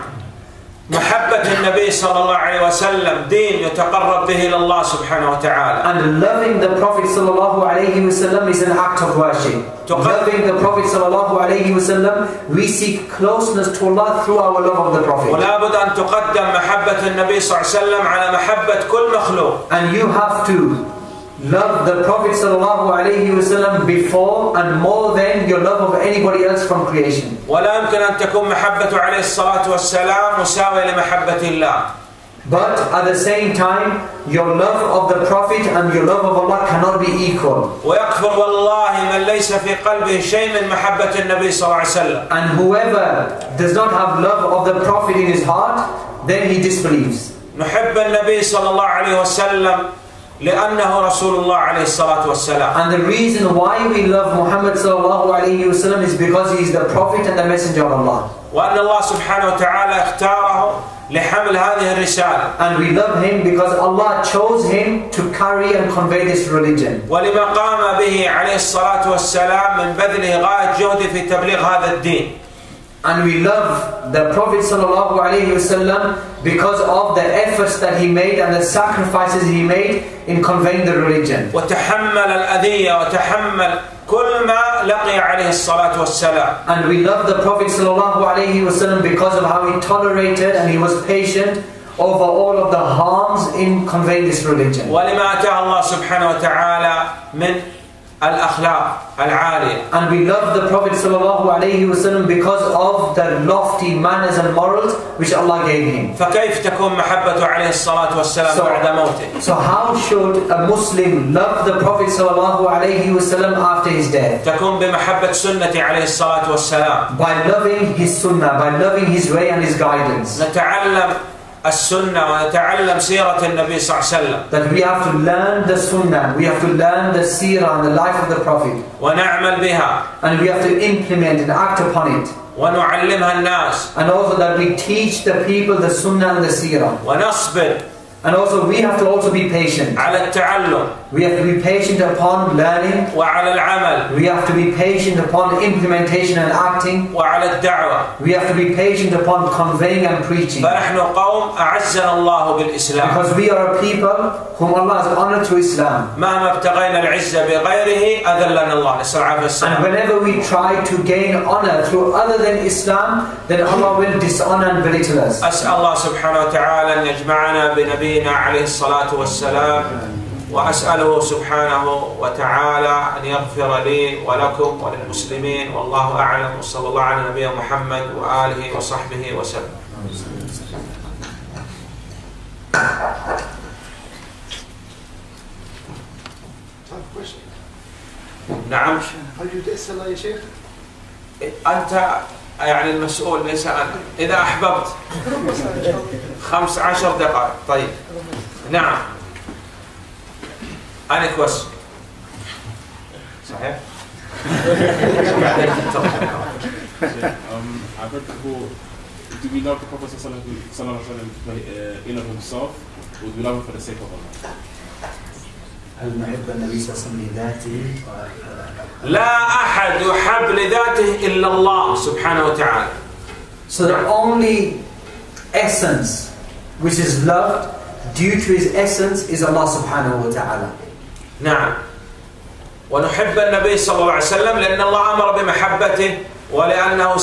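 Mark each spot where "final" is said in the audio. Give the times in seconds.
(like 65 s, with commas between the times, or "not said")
not said.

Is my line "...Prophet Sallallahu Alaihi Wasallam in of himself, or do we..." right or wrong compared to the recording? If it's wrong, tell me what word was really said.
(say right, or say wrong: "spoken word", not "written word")
right.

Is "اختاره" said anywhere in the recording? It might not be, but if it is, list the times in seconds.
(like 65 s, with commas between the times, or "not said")
60 s.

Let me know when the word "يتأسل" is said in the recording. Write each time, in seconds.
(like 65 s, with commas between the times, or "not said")
189 s.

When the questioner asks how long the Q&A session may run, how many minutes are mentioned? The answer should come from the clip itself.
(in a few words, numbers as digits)
15.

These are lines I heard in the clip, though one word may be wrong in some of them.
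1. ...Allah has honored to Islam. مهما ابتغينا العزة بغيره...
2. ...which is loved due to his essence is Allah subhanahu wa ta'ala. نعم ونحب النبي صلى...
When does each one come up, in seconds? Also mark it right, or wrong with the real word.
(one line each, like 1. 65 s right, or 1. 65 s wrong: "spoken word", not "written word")
1. 154 s right
2. 226 s right.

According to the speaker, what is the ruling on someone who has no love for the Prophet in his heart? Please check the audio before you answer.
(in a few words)
He disbelieves.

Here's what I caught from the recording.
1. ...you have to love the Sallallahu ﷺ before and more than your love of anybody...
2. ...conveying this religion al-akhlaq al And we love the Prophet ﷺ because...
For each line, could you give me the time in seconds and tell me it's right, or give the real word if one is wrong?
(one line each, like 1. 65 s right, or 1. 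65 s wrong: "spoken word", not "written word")
1. 19 s wrong: "Prophet", not "Sallallahu"
2. 93 s right.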